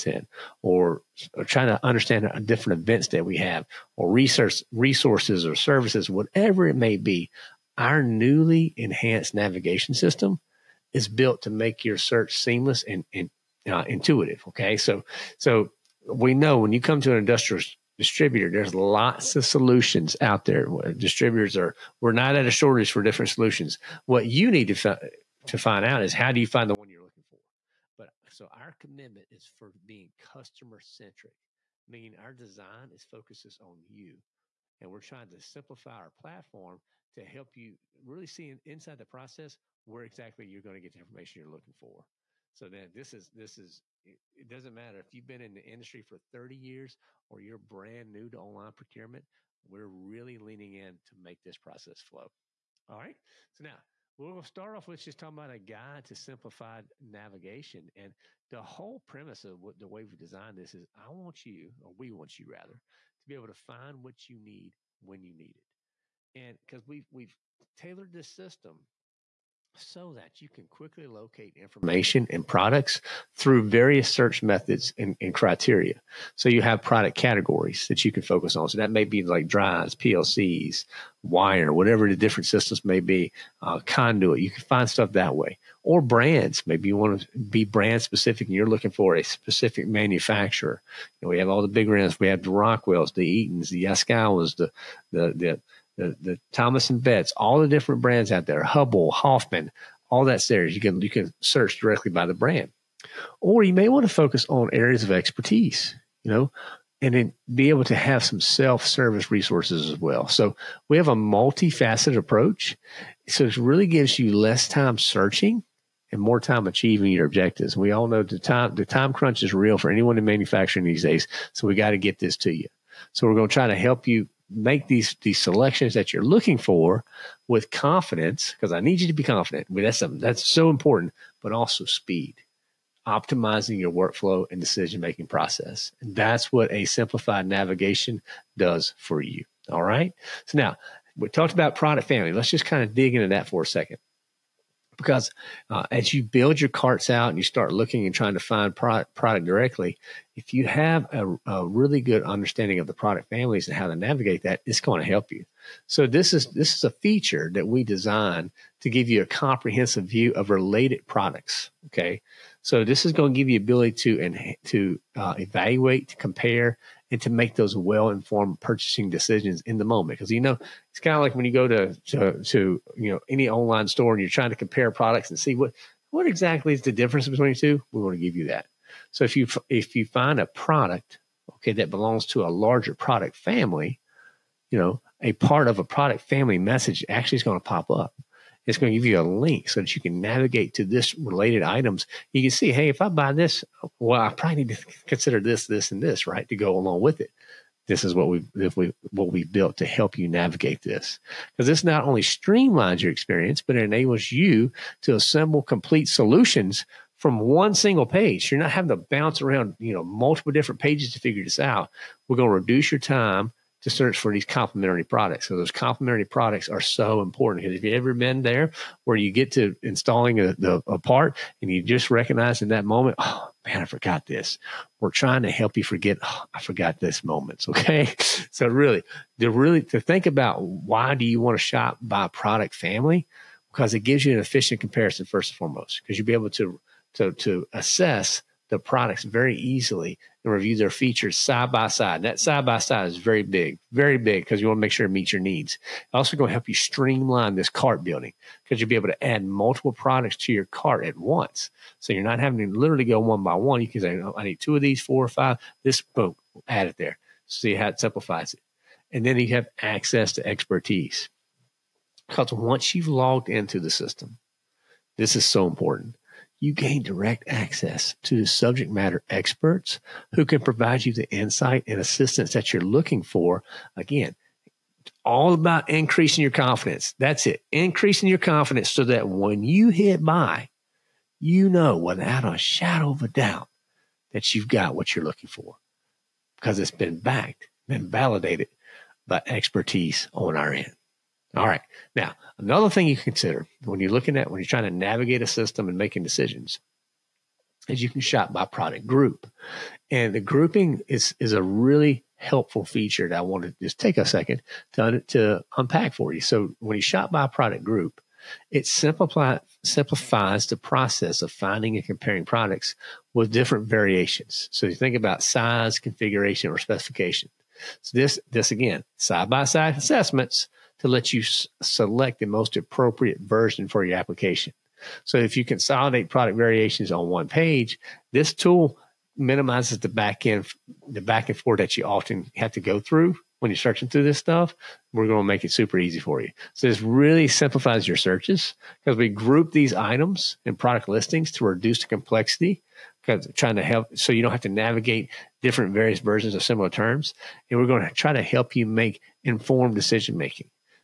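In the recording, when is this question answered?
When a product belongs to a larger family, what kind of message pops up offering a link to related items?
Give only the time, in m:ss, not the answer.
3:05.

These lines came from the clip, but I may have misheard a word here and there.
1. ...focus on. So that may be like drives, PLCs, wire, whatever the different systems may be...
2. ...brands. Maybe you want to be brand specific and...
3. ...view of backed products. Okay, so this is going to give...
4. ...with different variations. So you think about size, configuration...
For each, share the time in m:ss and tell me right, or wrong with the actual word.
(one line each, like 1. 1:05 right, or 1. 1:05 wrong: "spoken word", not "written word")
1. 1:18 right
2. 1:26 right
3. 2:40 wrong: "related", not "backed"
4. 5:13 right.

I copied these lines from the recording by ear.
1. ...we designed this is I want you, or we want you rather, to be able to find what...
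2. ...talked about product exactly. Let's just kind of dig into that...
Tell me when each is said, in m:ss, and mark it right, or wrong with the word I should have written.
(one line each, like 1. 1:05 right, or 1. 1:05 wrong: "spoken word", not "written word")
1. 1:00 right
2. 2:21 wrong: "family", not "exactly".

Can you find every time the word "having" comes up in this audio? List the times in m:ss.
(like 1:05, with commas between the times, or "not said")
3:28, 4:12.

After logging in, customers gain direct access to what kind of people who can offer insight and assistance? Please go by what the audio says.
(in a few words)
Subject matter experts.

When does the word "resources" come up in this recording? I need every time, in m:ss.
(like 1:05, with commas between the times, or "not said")
0:04, 1:49.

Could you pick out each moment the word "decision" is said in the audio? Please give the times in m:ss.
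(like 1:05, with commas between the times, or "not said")
2:14, 2:49, 4:56, 5:49.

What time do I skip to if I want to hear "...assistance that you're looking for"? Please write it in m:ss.
4:31.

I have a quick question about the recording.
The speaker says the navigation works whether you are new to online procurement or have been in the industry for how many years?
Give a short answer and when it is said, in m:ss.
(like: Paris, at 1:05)
30, at 0:46.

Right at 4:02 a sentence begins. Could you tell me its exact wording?
That side by side is very big, very big because you want to make sure it meets your needs.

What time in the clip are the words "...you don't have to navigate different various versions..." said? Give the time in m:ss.
5:44.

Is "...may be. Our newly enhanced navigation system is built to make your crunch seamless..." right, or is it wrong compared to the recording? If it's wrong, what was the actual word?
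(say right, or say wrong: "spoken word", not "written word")
wrong: "search", not "crunch".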